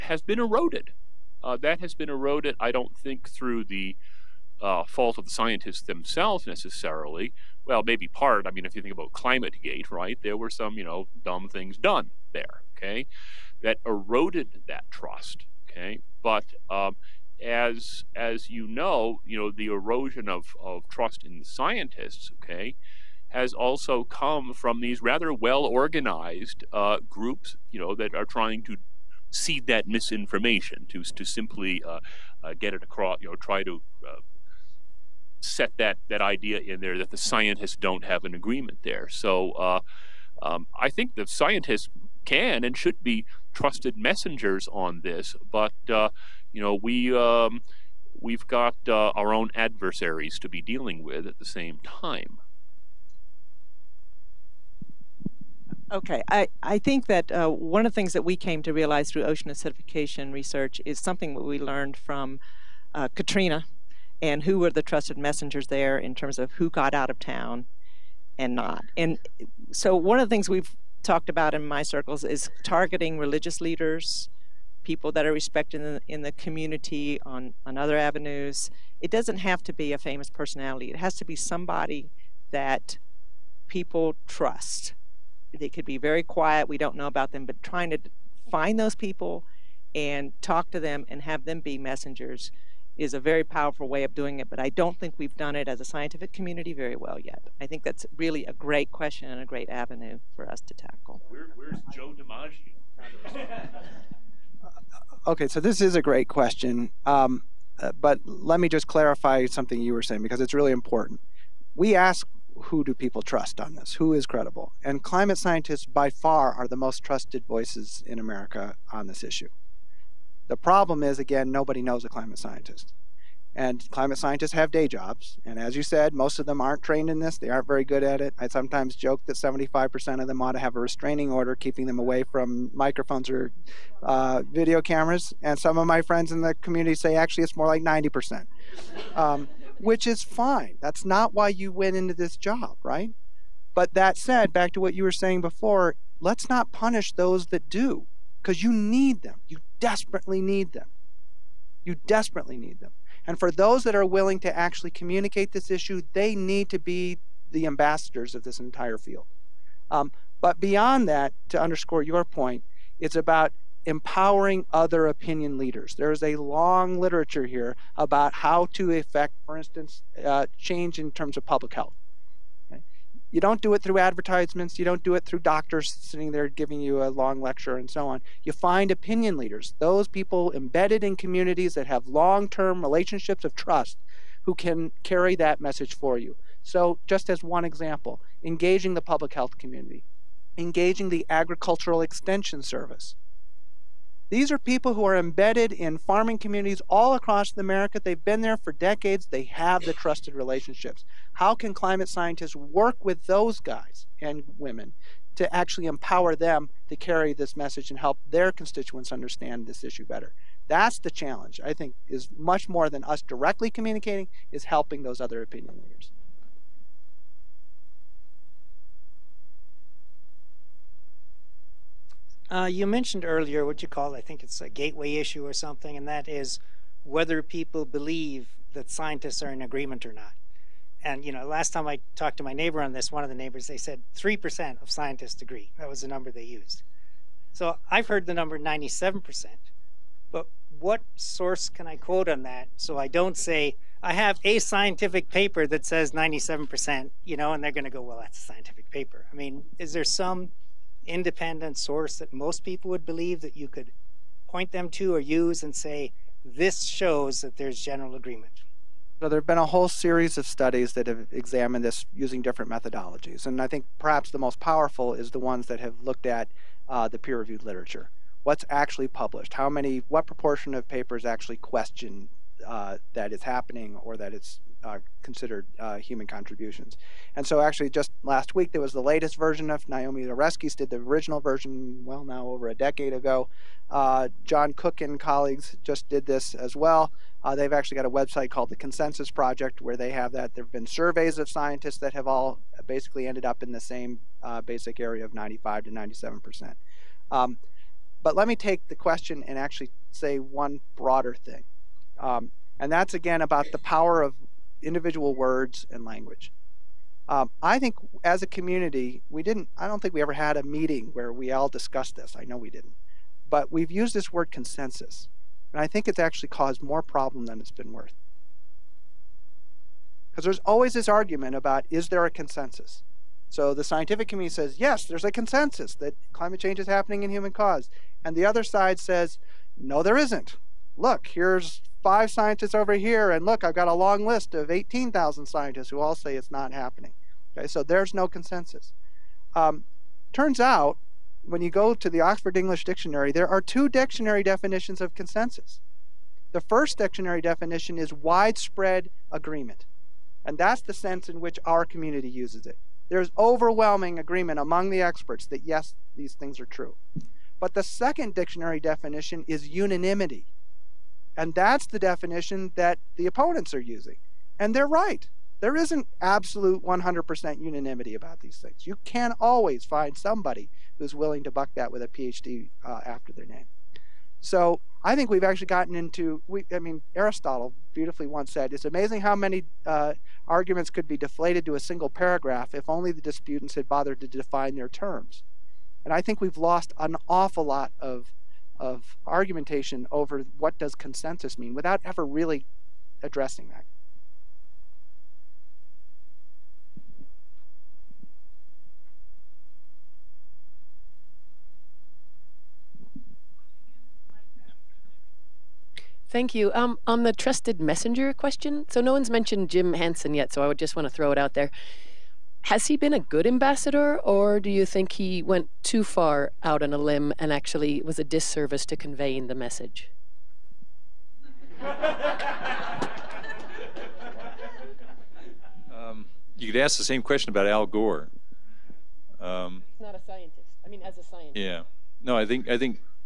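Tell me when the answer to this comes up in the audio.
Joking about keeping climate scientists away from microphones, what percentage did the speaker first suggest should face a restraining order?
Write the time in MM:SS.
02:09.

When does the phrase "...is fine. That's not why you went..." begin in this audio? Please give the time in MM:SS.
02:20.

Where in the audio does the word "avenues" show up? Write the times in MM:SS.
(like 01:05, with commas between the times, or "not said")
01:17, 01:39.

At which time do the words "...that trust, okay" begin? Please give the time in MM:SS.
00:14.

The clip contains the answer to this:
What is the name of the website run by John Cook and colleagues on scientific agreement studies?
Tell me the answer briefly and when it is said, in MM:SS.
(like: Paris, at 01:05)
Consensus Project, at 04:48.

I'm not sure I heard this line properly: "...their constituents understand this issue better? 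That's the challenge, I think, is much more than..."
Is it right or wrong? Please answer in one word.
right.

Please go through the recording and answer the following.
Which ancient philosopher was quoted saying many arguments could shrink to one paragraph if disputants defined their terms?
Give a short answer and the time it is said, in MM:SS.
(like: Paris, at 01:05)
Aristotle, at 06:17.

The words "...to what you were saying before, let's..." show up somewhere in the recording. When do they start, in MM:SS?
02:24.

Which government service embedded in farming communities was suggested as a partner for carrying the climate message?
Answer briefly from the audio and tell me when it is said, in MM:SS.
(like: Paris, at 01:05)
Agricultural Extension Service, at 03:11.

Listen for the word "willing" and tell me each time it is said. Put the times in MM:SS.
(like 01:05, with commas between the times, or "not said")
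02:34, 06:11.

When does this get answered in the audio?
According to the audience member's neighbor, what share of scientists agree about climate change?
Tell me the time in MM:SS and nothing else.
03:54.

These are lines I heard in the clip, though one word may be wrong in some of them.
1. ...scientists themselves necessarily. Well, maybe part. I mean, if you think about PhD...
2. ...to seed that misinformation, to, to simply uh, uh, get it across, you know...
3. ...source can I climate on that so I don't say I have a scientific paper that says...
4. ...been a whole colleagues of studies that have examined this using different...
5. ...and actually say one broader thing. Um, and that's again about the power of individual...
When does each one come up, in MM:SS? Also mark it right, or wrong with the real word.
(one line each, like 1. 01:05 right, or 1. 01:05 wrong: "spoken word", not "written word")
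1. 00:05 wrong: "ClimateGate", not "PhD"
2. 00:28 right
3. 04:01 wrong: "quote", not "climate"
4. 04:19 wrong: "series", not "colleagues"
5. 04:59 right.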